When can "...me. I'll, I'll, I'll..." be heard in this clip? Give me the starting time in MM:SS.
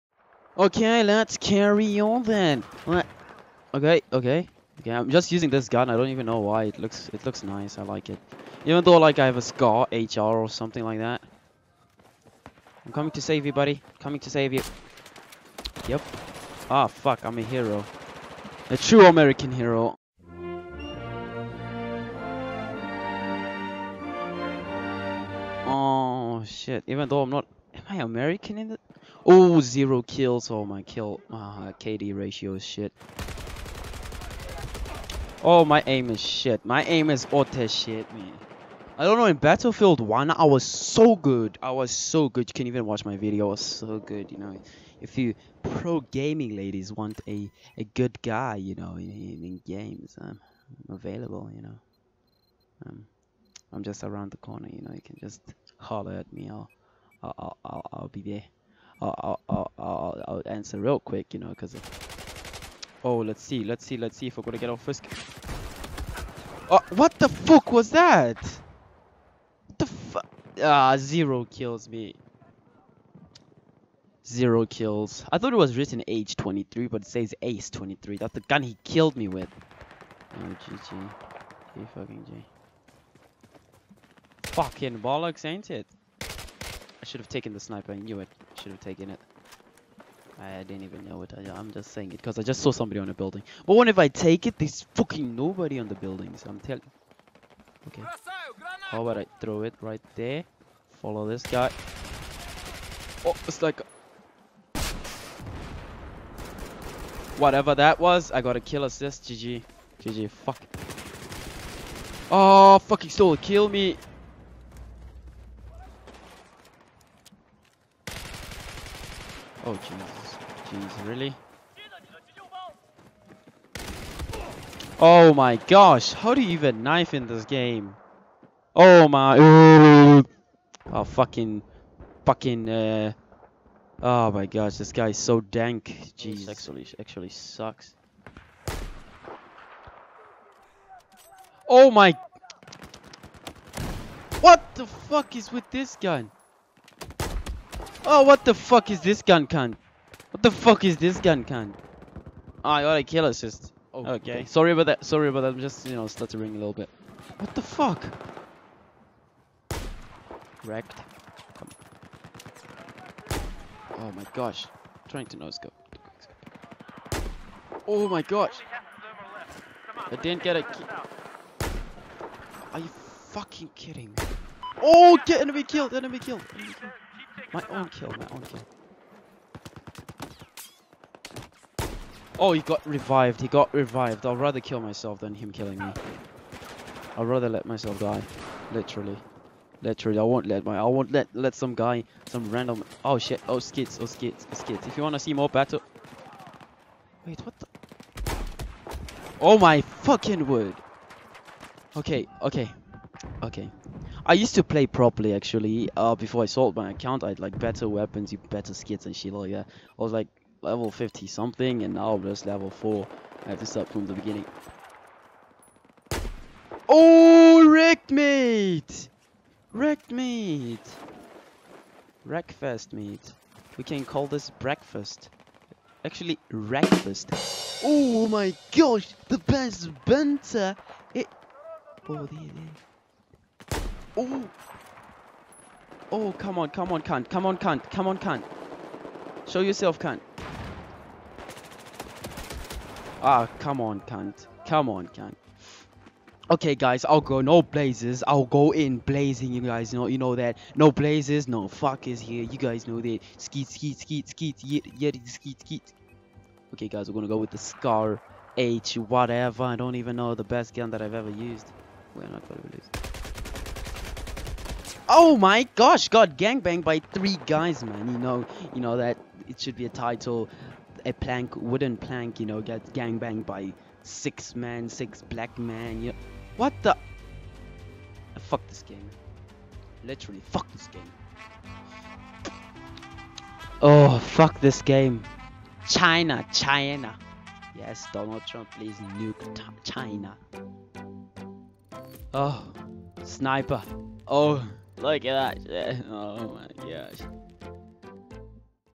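00:56.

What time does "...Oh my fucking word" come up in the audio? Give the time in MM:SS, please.
03:19.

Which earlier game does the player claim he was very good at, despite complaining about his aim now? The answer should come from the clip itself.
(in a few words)
Battlefield 1.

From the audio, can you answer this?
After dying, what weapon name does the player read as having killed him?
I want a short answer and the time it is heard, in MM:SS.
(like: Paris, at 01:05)
ACE 23, at 01:17.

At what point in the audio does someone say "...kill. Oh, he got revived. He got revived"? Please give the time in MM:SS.
02:58.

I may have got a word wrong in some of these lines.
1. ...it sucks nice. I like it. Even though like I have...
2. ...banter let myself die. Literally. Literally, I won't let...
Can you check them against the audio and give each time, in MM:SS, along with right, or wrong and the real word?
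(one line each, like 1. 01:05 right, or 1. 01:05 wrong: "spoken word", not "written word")
1. 00:07 wrong: "looks", not "sucks"
2. 03:07 wrong: "rather", not "banter".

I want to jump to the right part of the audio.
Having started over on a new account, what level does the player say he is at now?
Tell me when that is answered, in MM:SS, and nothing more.
03:32.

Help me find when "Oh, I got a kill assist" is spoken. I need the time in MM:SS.
02:32.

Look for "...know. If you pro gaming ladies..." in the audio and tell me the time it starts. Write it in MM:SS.
00:44.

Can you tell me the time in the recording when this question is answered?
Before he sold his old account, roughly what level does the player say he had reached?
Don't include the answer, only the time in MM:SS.
03:30.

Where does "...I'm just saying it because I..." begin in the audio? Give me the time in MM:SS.
01:31.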